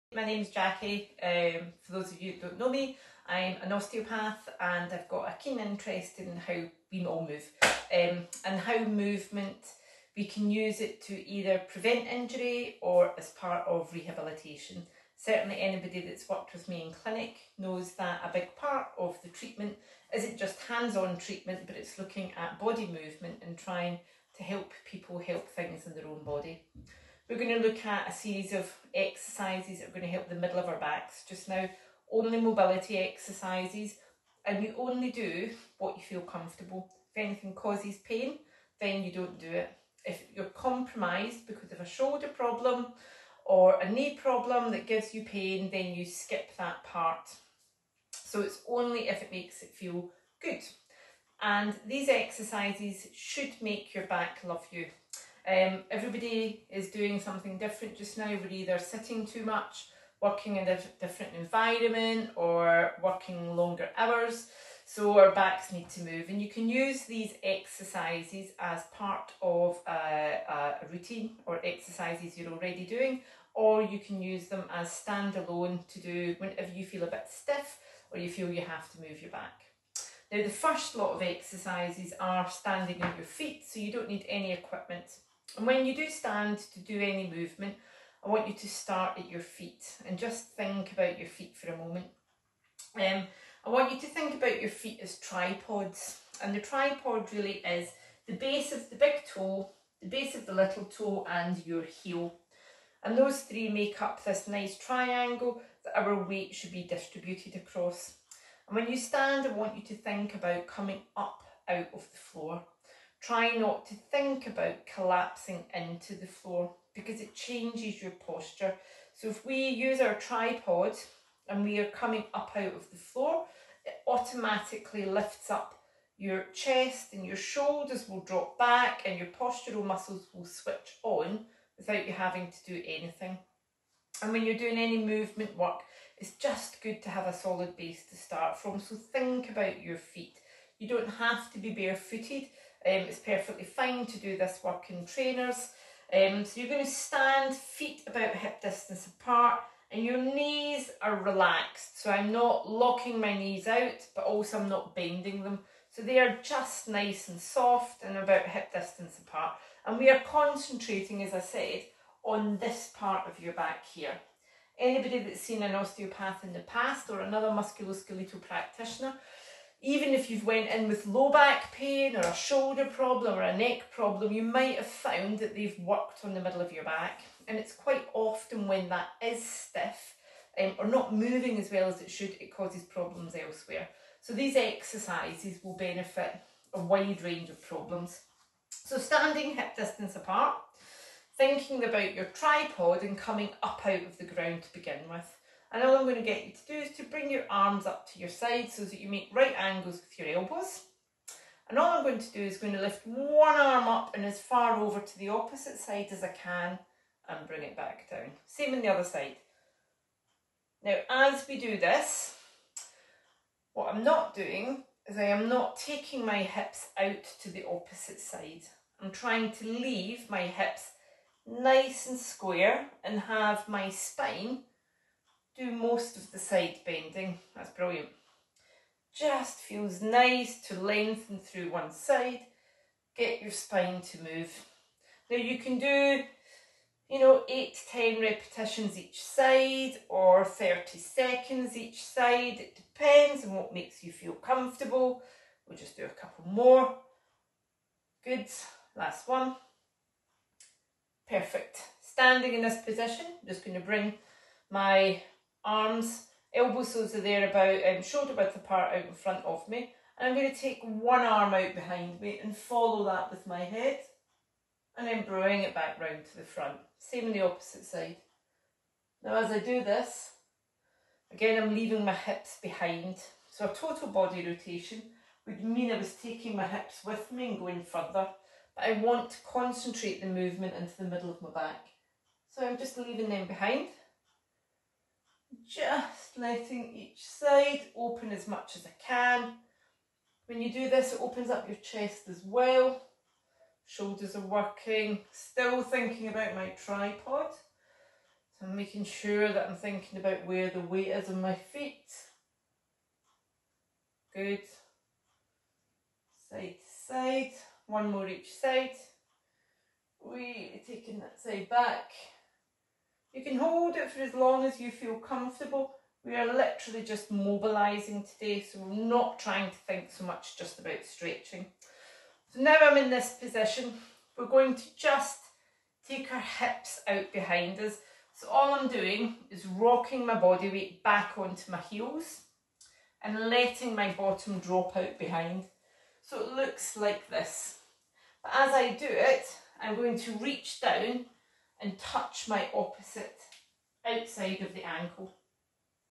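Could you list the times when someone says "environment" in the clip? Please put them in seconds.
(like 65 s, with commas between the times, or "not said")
61 s.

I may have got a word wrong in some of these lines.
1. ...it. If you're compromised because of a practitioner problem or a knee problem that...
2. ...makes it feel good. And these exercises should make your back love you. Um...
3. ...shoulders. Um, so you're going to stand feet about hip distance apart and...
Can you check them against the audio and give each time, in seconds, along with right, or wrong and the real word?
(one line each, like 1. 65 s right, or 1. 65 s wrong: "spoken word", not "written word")
1. 39 s wrong: "shoulder", not "practitioner"
2. 49 s right
3. 145 s wrong: "trainers", not "shoulders".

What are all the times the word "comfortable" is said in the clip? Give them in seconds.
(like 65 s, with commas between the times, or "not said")
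36 s, 244 s, 315 s.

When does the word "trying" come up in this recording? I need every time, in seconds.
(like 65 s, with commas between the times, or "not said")
23 s, 219 s, 319 s.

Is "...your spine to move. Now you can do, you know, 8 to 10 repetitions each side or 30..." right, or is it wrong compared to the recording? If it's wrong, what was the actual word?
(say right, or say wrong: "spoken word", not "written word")
right.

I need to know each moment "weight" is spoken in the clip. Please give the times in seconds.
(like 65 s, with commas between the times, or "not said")
106 s, 300 s, 330 s.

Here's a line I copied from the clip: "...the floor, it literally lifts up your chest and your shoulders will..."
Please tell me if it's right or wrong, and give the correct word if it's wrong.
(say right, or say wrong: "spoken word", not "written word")
wrong: "automatically", not "literally".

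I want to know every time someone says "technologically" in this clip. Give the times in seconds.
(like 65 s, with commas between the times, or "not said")
not said.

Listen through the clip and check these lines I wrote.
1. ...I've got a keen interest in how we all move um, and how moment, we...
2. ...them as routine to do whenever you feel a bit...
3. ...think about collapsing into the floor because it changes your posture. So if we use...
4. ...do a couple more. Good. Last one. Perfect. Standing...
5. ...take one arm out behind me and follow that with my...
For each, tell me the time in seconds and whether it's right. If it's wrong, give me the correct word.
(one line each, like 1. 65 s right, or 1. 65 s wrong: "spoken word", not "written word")
1. 4 s wrong: "movement", not "moment"
2. 74 s wrong: "standalone", not "routine"
3. 114 s right
4. 245 s right
5. 260 s right.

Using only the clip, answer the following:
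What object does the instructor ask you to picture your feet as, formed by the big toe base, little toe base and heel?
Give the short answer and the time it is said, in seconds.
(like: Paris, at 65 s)
Tripods, at 95 s.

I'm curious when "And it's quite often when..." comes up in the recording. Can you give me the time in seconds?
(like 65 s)
177 s.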